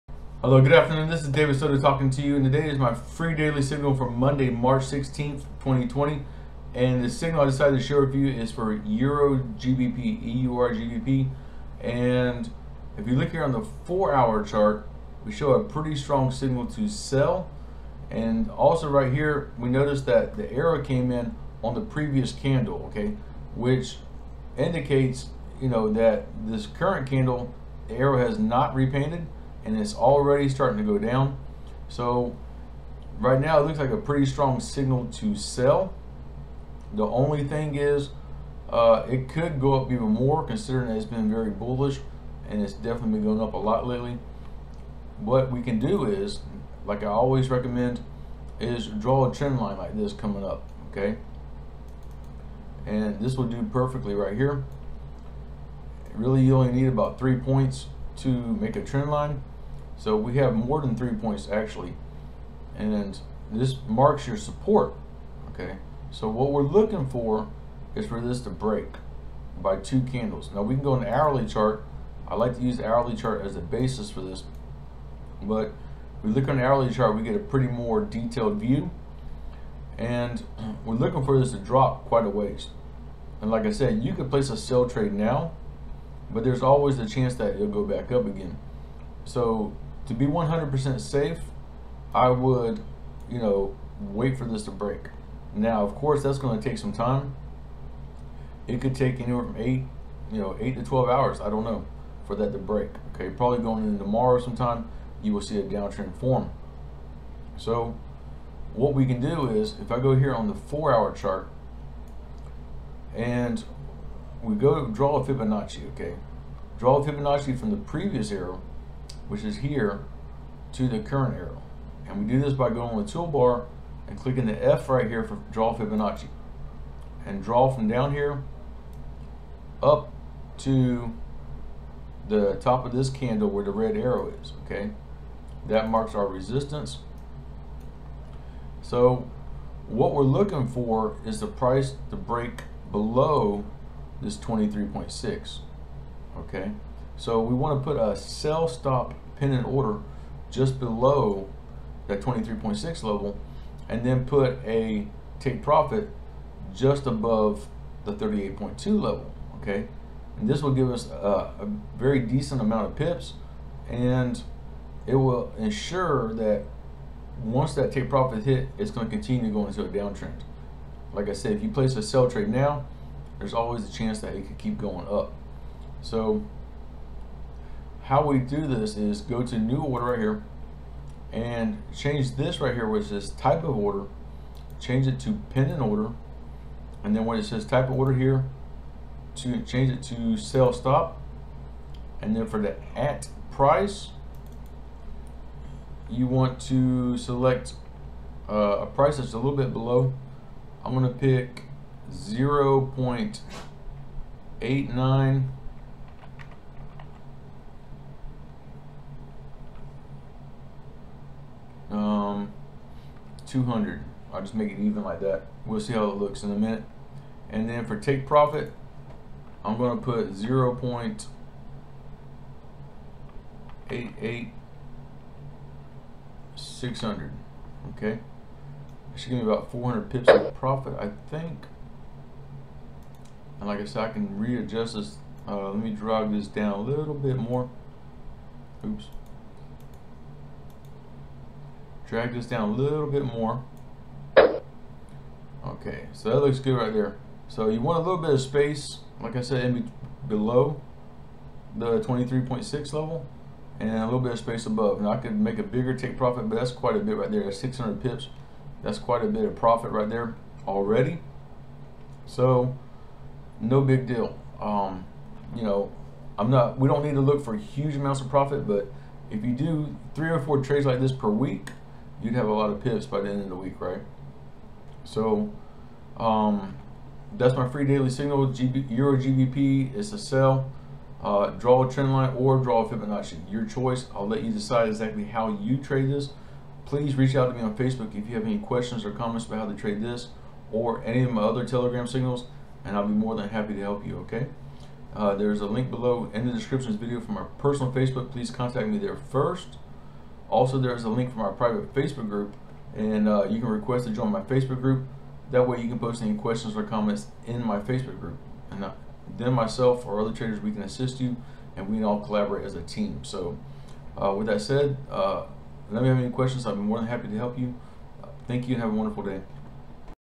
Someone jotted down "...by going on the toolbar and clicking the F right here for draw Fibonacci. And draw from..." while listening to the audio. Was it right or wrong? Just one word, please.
right.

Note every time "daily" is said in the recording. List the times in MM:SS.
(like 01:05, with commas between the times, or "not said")
00:03, 04:37.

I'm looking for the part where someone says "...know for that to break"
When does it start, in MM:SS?
01:41.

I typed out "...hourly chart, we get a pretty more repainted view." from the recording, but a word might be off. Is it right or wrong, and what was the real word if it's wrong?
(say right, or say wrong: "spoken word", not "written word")
wrong: "detailed", not "repainted".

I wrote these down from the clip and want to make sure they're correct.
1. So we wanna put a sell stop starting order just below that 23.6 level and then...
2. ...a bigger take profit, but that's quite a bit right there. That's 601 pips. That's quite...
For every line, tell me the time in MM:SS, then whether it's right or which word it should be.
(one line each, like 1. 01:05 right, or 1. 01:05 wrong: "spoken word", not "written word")
1. 02:27 wrong: "pending", not "starting"
2. 04:15 wrong: "600", not "601".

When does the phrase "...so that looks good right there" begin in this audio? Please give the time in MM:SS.
04:06.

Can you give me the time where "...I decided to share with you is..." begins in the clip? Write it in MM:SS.
00:07.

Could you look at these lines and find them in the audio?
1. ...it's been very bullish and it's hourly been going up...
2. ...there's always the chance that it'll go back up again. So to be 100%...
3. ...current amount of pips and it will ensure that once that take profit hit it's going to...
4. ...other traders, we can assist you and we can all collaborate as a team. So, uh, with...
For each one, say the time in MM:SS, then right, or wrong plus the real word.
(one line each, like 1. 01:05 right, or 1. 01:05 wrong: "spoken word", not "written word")
1. 00:40 wrong: "definitely", not "hourly"
2. 01:26 right
3. 02:42 wrong: "decent", not "current"
4. 05:10 right.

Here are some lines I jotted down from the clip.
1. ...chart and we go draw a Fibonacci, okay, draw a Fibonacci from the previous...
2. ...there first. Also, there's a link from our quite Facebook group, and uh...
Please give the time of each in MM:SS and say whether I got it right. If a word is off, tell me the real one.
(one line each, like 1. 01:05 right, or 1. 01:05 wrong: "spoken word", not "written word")
1. 01:51 right
2. 04:58 wrong: "private", not "quite".